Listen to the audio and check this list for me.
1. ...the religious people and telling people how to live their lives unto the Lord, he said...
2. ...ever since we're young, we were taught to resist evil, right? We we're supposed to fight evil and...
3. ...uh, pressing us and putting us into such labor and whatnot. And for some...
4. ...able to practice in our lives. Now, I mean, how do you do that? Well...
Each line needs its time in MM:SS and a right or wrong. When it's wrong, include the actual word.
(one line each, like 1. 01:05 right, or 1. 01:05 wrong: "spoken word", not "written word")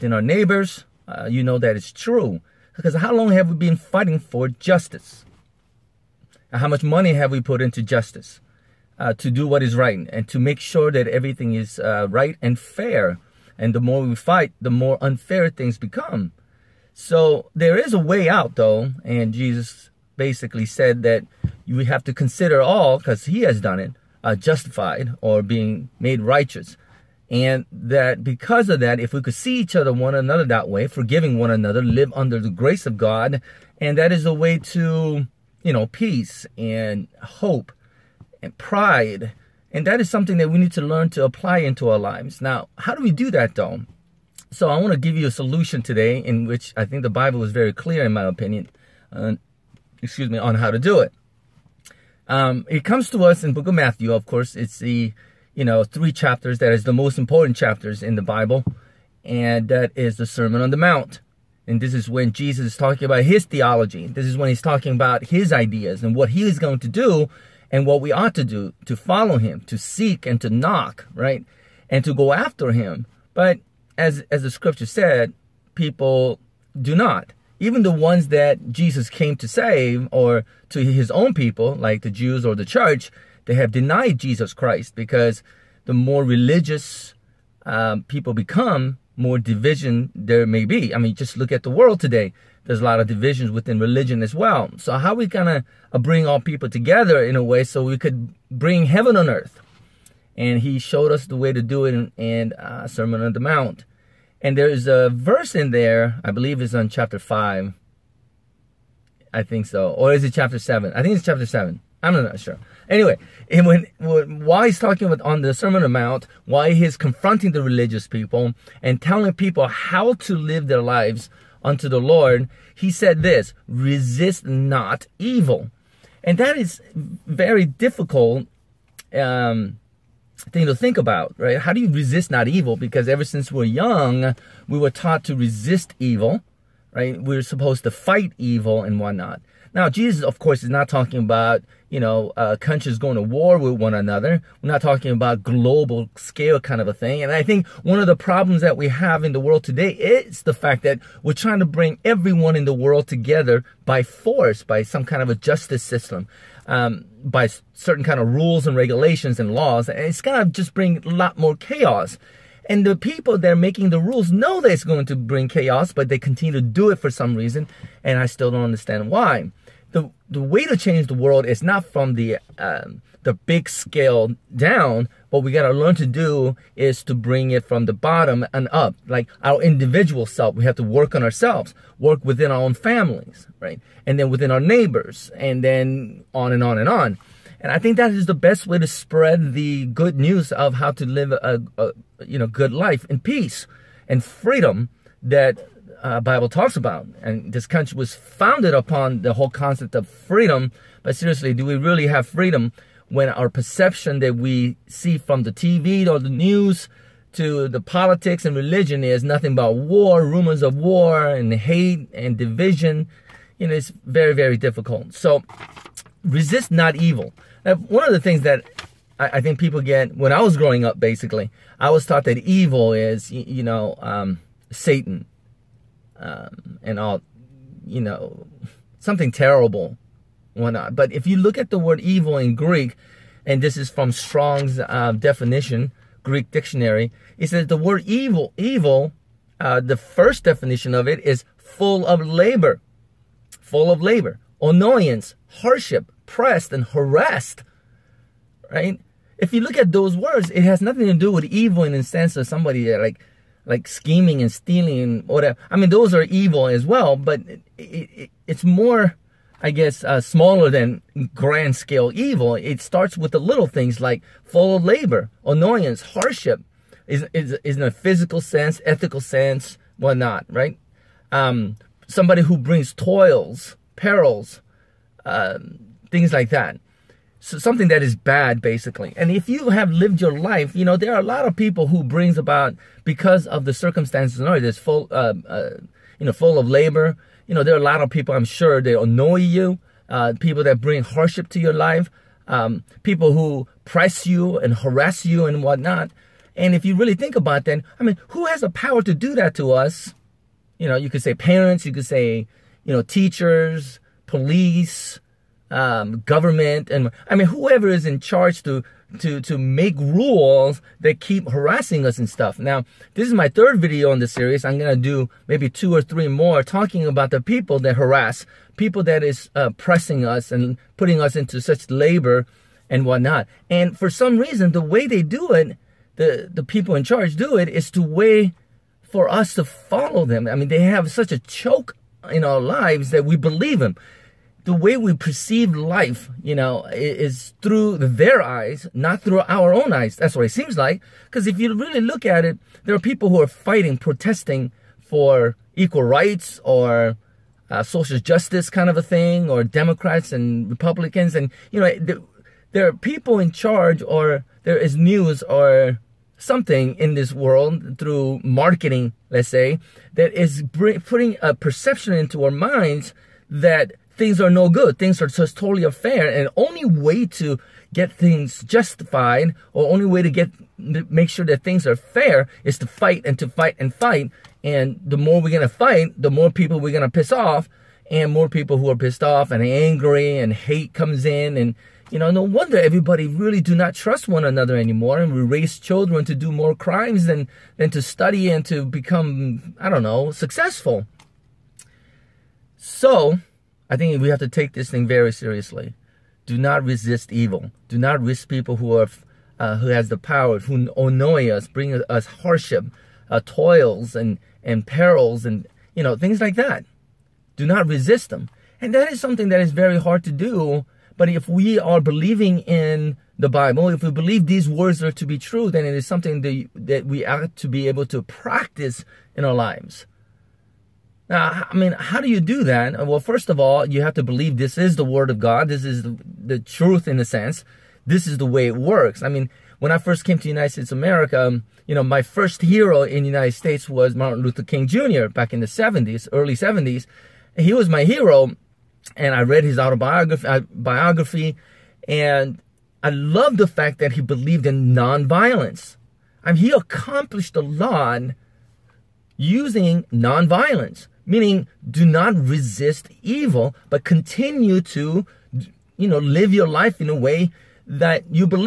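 1. 01:57 right
2. 02:13 right
3. 05:19 right
4. 06:57 right.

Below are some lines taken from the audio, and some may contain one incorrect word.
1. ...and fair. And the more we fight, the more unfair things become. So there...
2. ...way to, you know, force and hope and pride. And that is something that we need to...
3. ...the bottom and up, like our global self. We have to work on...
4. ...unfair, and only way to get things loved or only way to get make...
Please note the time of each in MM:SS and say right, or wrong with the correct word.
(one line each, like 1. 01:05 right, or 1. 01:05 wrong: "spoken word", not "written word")
1. 00:12 right
2. 00:34 wrong: "peace", not "force"
3. 02:57 wrong: "individual", not "global"
4. 06:05 wrong: "justified", not "loved".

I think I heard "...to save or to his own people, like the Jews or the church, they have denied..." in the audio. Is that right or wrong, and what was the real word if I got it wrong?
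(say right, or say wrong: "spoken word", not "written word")
right.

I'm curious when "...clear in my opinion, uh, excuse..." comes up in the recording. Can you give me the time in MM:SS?
00:47.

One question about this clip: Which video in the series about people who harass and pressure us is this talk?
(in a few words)
Third video.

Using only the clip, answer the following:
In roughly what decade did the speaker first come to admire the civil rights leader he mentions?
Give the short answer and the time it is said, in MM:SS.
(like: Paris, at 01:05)
The 70s, at 07:15.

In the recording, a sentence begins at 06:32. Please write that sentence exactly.
So, I think we have to take this thing very seriously.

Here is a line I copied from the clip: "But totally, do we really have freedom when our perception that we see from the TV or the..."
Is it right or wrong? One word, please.
wrong.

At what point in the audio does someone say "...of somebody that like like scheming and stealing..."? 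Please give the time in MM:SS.
04:12.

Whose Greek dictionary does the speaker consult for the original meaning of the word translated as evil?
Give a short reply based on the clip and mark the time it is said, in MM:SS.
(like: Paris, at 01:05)
Strong's, at 03:54.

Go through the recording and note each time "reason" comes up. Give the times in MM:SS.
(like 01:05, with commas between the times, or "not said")
02:47, 05:24.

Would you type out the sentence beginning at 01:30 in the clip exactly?
I mean, just look at the world today there's a lot of divisions within religion as well.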